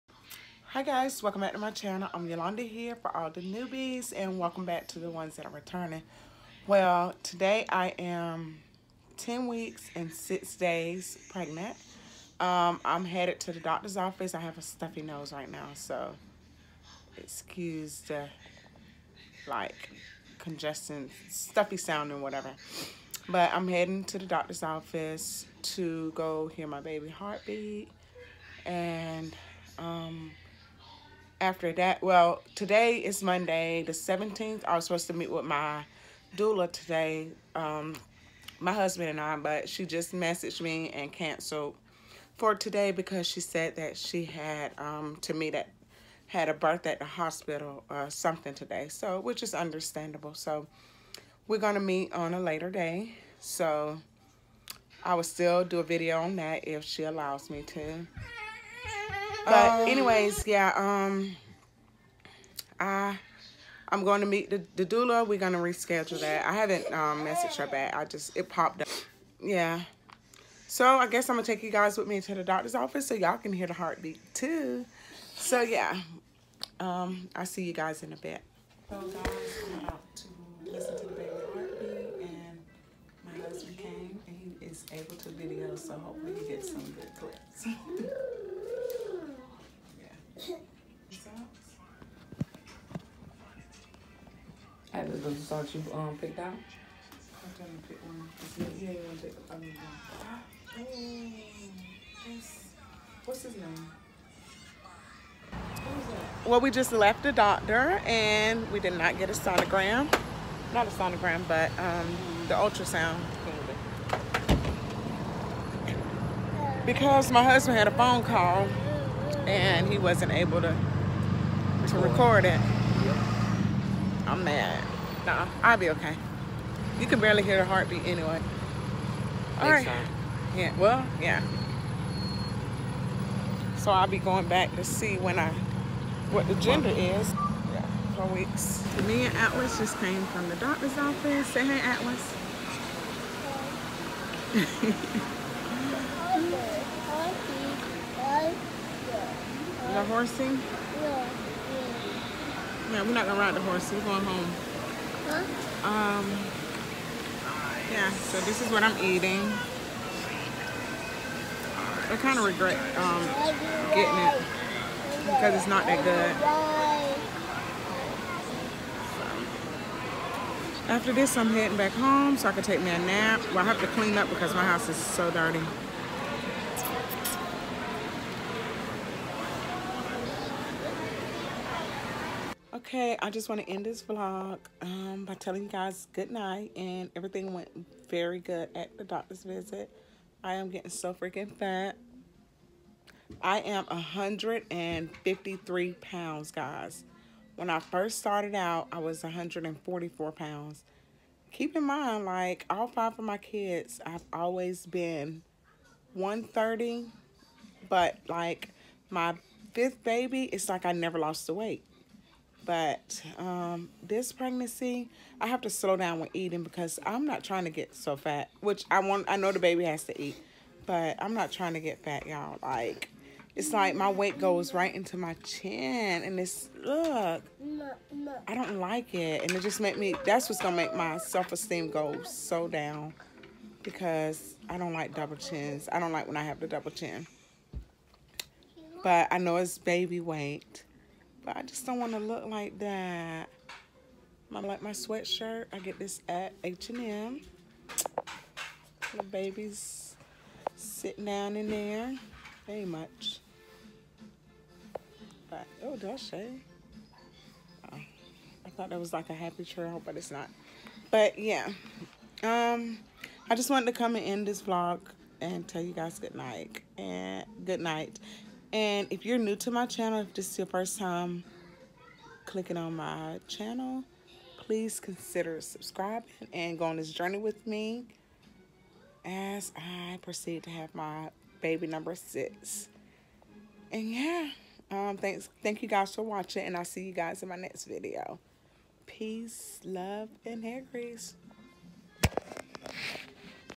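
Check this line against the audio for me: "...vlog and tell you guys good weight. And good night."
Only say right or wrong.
wrong.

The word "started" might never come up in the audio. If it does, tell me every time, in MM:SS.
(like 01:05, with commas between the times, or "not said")
03:18.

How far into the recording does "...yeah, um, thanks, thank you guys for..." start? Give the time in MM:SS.
04:44.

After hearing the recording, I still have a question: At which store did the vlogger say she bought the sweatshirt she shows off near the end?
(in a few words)
H&M.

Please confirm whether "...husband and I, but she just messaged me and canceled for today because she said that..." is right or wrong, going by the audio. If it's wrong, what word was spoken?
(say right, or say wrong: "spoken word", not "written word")
right.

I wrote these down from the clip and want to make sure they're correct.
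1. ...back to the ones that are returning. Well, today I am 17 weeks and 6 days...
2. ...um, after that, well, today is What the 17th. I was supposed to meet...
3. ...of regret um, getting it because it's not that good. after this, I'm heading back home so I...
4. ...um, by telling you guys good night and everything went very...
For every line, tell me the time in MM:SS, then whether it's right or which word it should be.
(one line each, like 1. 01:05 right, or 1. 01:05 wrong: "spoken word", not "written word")
1. 00:04 wrong: "10", not "17"
2. 00:29 wrong: "Monday", not "What"
3. 02:42 right
4. 03:04 right.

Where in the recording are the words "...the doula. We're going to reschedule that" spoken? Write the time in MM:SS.
01:04.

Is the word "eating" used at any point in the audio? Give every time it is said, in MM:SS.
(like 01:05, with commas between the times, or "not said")
02:39, 03:36.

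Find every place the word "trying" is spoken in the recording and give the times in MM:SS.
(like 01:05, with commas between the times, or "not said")
01:37, 03:37, 03:41.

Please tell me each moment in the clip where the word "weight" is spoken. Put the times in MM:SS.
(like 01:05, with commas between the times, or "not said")
03:31, 03:44, 04:00.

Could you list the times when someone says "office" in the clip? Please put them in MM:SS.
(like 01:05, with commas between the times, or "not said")
00:13, 00:24, 01:12, 02:20.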